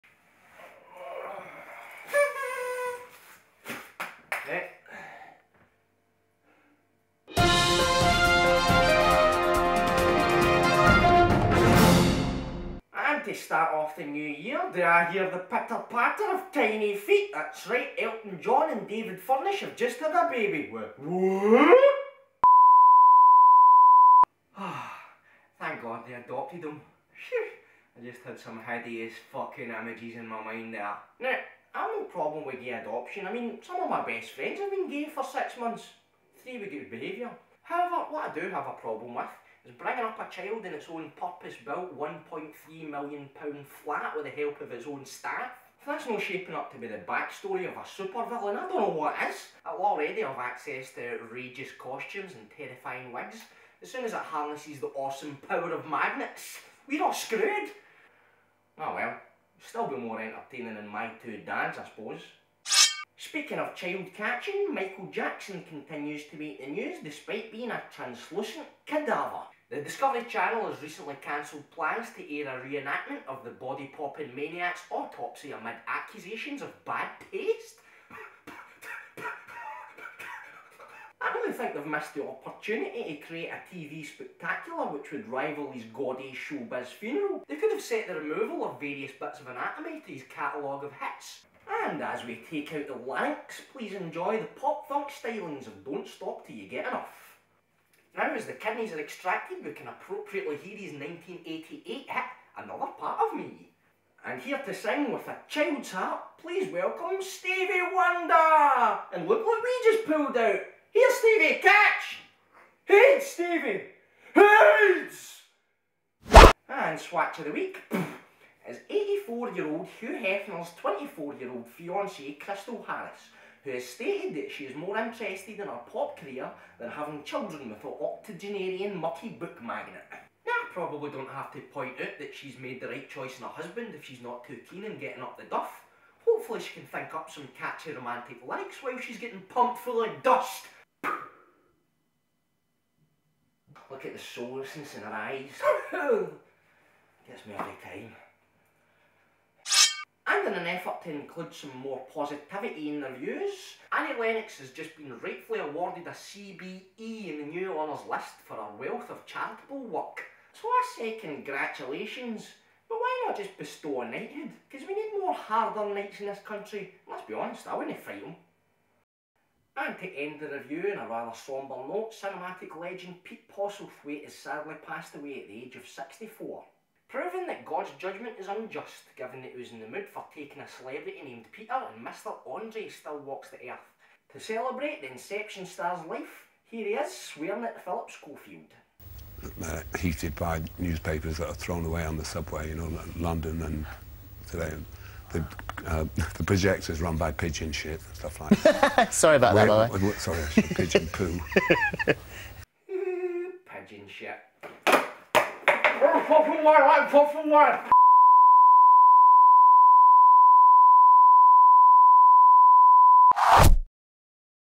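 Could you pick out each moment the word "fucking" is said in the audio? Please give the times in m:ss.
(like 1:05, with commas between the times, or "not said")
0:29.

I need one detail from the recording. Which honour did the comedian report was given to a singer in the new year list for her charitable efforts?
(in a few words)
CBE.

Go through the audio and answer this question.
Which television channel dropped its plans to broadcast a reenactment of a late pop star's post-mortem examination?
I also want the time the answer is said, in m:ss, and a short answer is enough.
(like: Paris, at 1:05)
Discovery Channel, at 1:09.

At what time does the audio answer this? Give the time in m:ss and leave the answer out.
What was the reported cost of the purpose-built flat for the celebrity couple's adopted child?
0:41.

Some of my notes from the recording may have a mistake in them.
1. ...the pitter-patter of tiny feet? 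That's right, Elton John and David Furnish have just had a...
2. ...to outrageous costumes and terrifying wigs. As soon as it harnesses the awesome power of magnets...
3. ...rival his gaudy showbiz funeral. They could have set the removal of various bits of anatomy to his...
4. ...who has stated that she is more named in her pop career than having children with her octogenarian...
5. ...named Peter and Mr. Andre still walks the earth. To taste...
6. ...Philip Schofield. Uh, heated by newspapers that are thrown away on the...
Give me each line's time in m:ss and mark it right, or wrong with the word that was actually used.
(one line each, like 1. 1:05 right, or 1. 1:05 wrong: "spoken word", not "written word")
1. 0:15 right
2. 0:50 right
3. 1:25 right
4. 2:03 wrong: "interested", not "named"
5. 3:01 wrong: "celebrate", not "taste"
6. 3:07 right.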